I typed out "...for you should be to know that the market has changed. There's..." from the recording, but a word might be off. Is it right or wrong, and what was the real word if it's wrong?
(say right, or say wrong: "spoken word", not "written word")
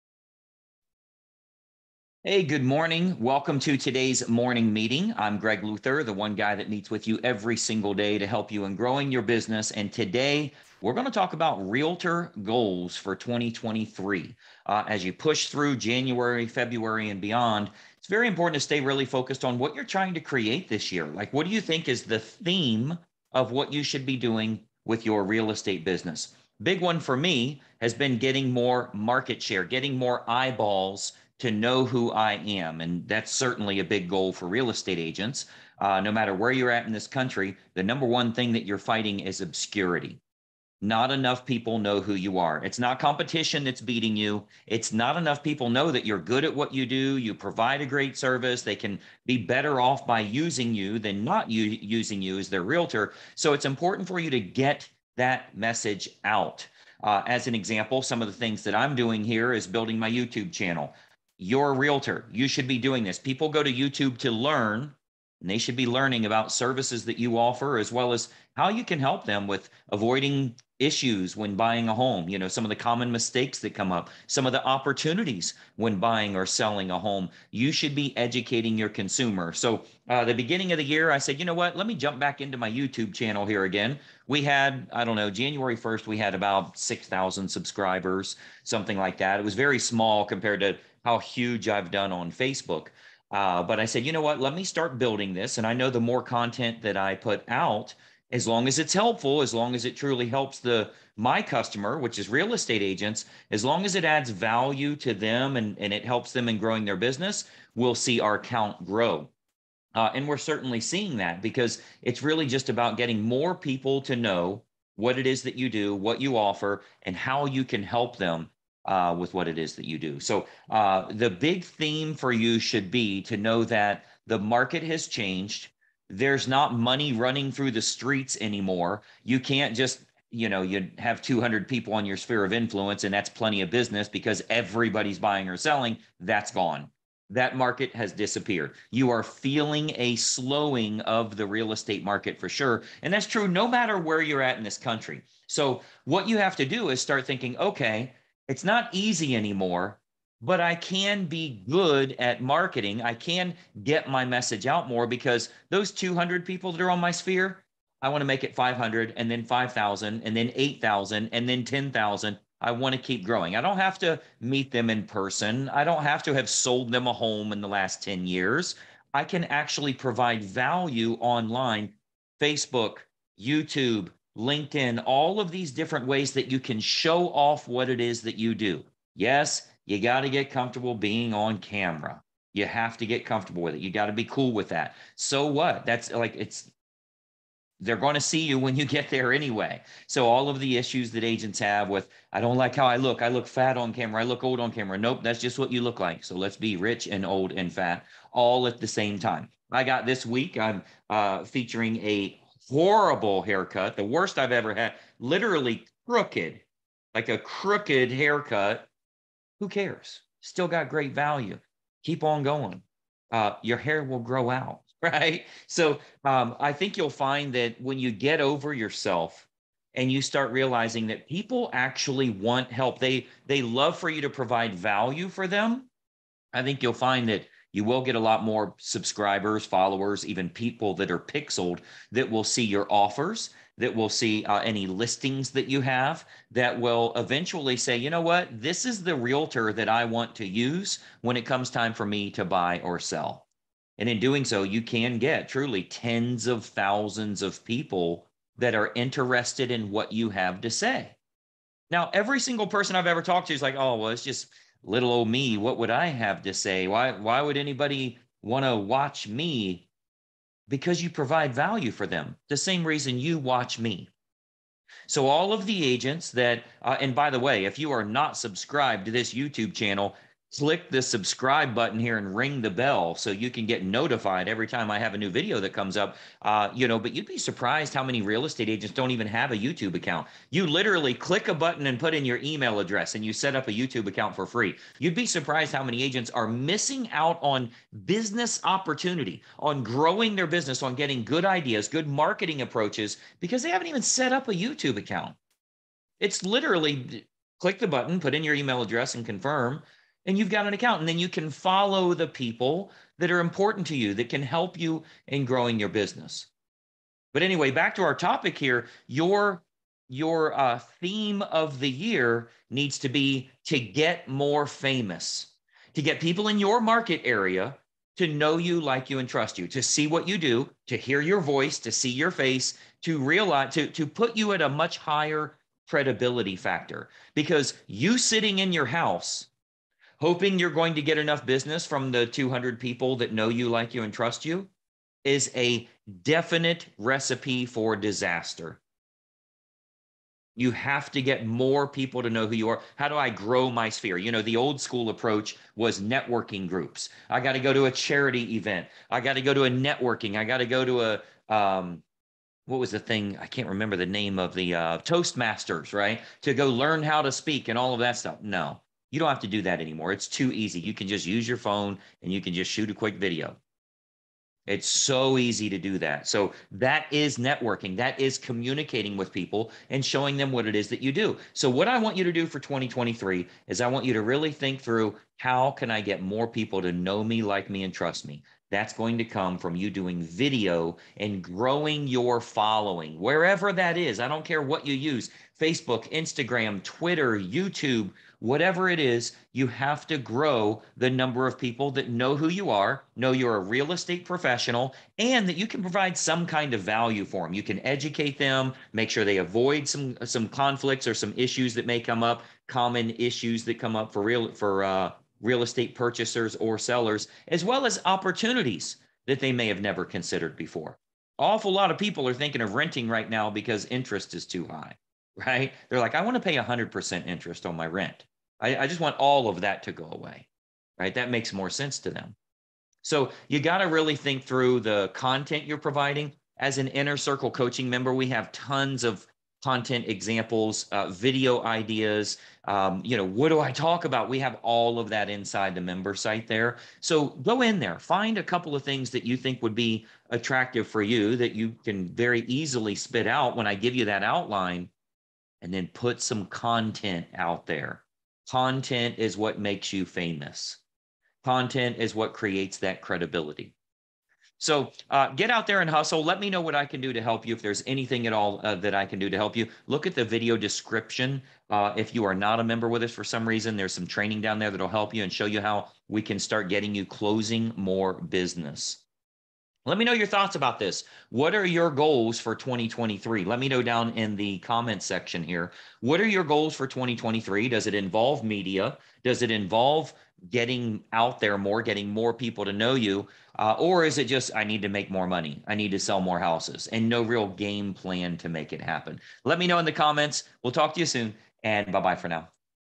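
right.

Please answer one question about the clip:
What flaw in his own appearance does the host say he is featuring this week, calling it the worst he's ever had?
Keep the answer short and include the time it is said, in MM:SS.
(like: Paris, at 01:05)
Crooked haircut, at 03:27.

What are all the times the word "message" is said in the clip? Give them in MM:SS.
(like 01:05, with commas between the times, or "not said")
00:55, 02:34.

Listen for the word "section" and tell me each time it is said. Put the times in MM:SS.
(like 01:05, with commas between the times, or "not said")
07:55.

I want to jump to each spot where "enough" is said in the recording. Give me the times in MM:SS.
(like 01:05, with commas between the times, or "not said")
00:41, 00:45, 05:31.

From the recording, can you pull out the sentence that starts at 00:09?
And today we're going to talk about realtor goals for 2023.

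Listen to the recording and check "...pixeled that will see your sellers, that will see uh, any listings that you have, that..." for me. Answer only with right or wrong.
wrong.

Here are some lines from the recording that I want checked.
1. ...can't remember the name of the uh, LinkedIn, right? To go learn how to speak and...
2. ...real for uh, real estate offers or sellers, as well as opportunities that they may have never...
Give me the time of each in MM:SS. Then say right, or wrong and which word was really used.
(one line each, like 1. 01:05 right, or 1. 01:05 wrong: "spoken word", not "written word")
1. 05:53 wrong: "Toastmasters", not "LinkedIn"
2. 06:44 wrong: "purchasers", not "offers".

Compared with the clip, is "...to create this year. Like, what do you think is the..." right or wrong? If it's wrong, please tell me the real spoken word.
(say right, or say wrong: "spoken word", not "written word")
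right.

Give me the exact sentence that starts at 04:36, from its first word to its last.
Uh, you know, but you'd be surprised how many real estate agents don't even have a YouTube account.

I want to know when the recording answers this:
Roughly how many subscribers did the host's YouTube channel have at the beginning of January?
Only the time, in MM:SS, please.
01:26.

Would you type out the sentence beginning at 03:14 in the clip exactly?
Nope, that's just what you look like.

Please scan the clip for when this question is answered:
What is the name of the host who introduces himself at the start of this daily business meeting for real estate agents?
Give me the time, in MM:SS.
00:05.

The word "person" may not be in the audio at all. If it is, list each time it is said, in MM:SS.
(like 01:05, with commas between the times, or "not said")
02:45, 04:12.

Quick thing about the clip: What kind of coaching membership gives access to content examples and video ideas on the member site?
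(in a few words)
Inner circle coaching.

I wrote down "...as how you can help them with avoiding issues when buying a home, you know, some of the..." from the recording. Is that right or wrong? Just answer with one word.
right.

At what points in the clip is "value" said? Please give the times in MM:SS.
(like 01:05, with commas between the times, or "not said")
01:44, 02:50, 03:31, 03:44, 04:21, 06:36.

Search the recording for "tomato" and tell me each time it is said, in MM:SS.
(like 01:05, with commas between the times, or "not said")
not said.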